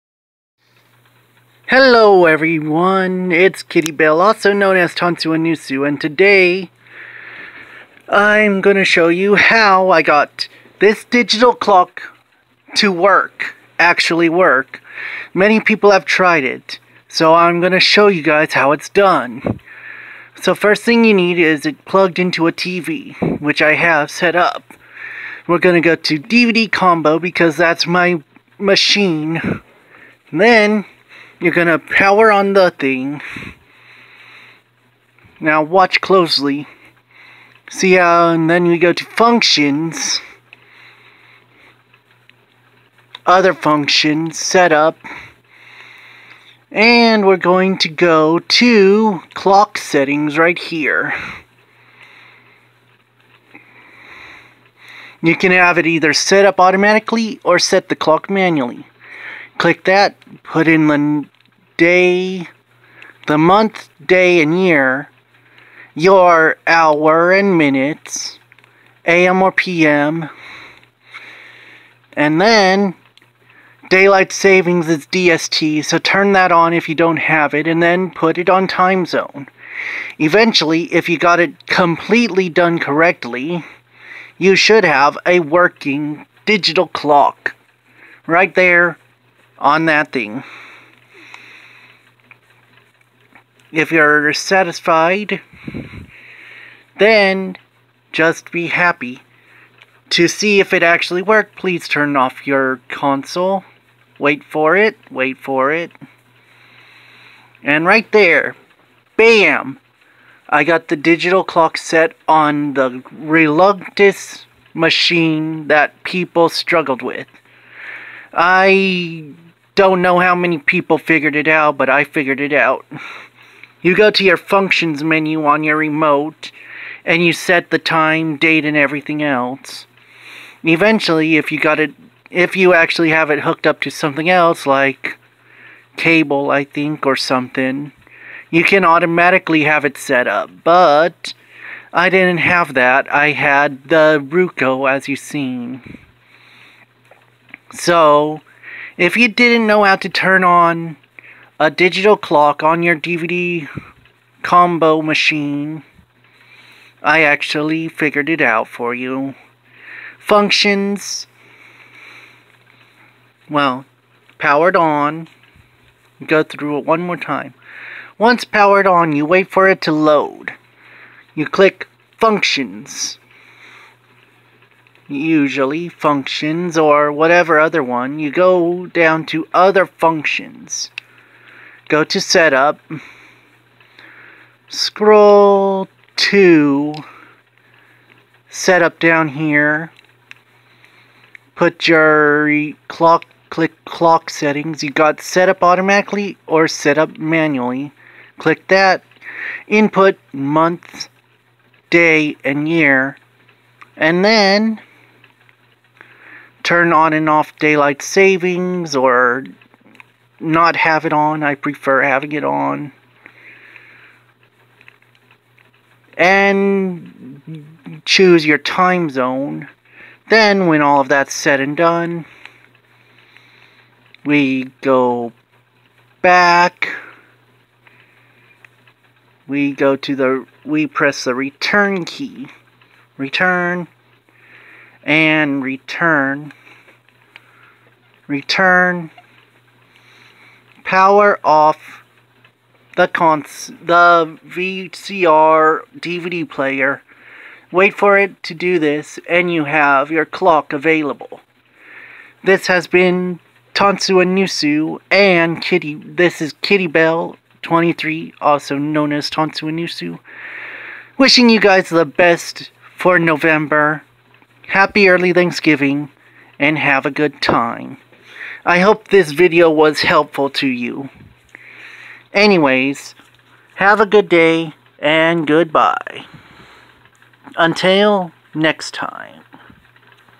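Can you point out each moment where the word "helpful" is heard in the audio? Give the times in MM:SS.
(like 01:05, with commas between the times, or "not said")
04:30.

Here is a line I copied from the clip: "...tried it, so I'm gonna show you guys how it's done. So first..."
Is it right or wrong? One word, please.
right.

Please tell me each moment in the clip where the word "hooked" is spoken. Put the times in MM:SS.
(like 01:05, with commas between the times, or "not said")
02:13.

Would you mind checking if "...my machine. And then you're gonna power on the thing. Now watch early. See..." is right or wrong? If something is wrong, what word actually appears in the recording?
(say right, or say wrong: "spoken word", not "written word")
wrong: "closely", not "early".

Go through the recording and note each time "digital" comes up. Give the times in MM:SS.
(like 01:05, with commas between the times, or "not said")
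00:11, 01:26, 01:50, 02:31.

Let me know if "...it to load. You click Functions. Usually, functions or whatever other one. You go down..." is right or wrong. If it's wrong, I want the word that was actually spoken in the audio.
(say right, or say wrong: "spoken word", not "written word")
right.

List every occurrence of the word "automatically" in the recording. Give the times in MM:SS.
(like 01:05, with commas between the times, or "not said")
00:56, 02:18, 03:15.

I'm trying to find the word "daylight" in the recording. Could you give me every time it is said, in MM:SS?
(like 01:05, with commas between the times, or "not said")
01:13, 03:27.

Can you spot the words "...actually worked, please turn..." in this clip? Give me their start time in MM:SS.
01:40.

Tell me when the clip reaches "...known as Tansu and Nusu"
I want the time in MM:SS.
04:18.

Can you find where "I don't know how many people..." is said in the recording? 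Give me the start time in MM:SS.
01:58.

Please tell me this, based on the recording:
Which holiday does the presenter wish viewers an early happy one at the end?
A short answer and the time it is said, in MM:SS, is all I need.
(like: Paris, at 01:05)
Thanksgiving, at 04:25.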